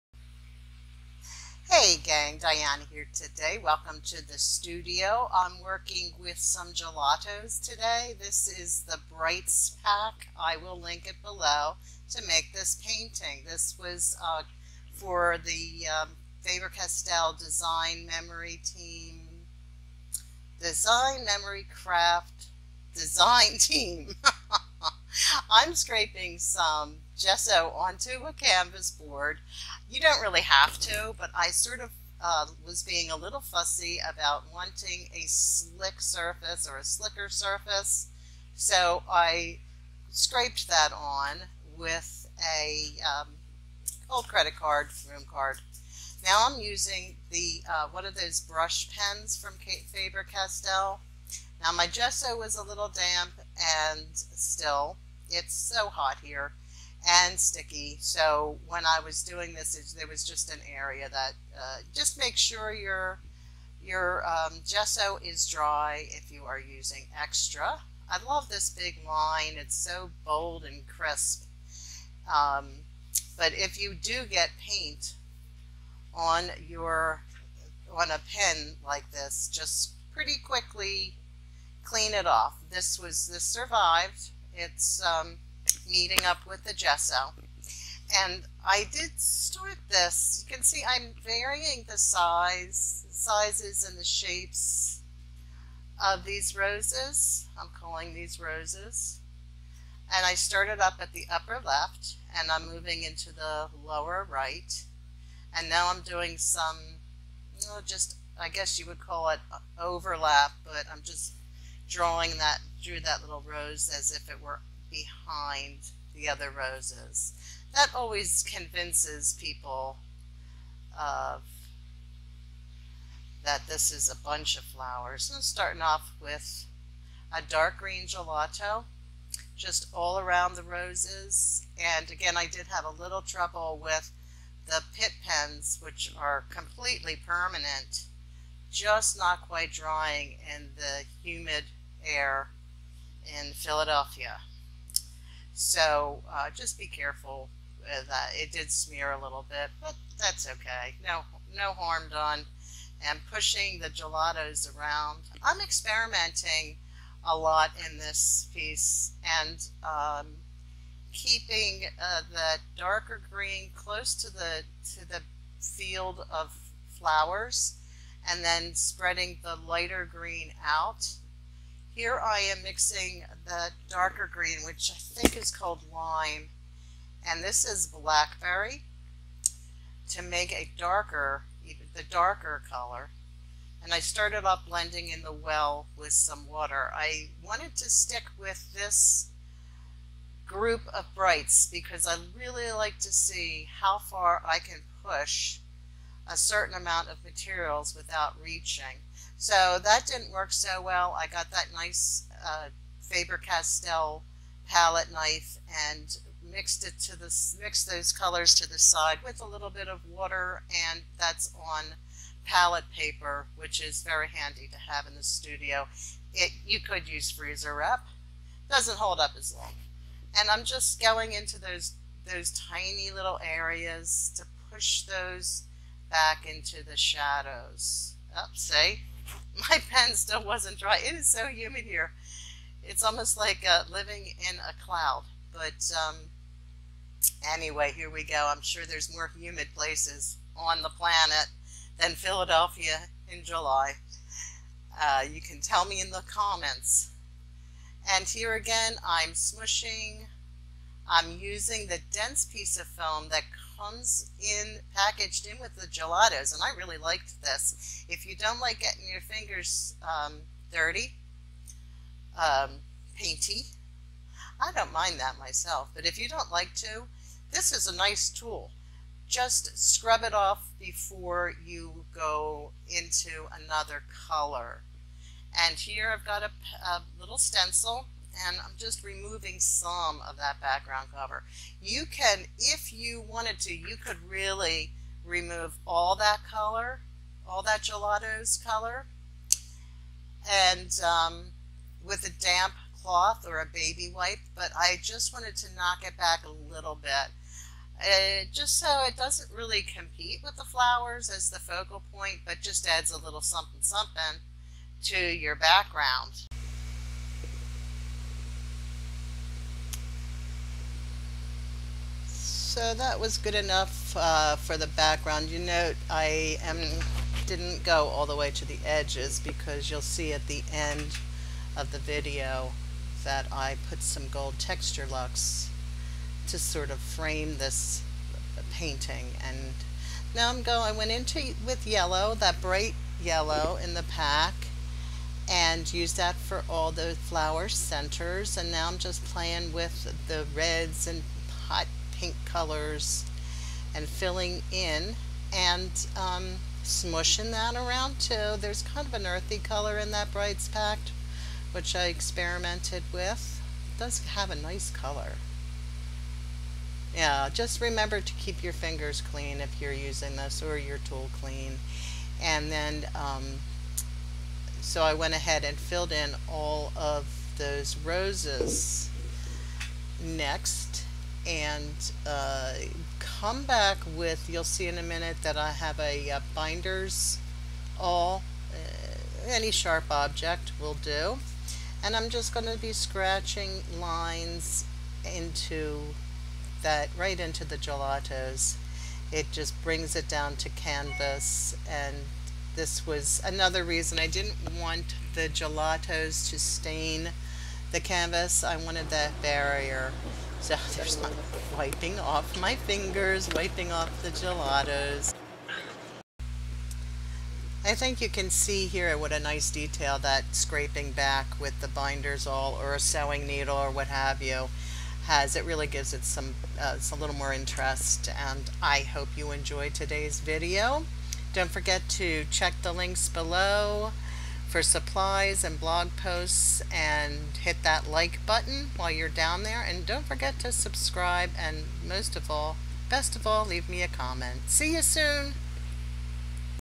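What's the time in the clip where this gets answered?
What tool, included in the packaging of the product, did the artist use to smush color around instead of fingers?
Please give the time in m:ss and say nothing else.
4:12.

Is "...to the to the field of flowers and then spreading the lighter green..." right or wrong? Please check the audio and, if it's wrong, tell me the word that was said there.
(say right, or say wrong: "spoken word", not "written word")
right.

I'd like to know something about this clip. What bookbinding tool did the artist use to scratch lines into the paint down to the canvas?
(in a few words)
binder's awl.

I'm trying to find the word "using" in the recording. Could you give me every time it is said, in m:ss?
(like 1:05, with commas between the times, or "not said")
0:46, 1:06, 4:11, 5:59.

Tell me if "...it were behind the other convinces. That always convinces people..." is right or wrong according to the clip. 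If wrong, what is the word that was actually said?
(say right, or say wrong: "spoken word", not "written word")
wrong: "roses", not "convinces".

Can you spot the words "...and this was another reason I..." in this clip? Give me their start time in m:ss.
6:31.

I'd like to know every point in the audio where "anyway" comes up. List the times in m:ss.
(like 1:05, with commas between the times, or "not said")
3:57.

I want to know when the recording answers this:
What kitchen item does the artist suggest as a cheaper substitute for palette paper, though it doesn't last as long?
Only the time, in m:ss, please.
3:37.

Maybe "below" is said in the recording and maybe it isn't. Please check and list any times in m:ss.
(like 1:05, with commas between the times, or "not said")
0:11, 7:03.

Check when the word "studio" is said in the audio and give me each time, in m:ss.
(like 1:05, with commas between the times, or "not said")
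0:04, 3:35.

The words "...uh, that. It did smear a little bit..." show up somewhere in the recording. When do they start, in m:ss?
2:28.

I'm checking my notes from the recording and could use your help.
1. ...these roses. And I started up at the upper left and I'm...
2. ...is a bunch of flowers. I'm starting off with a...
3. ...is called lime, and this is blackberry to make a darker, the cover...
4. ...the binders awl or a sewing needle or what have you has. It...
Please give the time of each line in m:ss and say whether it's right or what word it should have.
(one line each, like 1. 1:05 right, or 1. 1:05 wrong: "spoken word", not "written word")
1. 1:38 right
2. 2:03 right
3. 2:55 wrong: "darker", not "cover"
4. 6:51 right.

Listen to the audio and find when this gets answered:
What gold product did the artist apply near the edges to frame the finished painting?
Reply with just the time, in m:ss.
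5:24.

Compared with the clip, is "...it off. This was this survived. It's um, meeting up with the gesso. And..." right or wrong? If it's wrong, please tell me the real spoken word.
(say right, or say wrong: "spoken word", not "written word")
right.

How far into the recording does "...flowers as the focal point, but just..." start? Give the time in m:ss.
5:00.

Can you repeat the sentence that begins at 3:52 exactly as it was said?
It's almost like uh, living in a cloud.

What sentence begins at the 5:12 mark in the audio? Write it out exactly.
So that was good enough uh, for the background.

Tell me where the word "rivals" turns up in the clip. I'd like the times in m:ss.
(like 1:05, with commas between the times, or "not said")
not said.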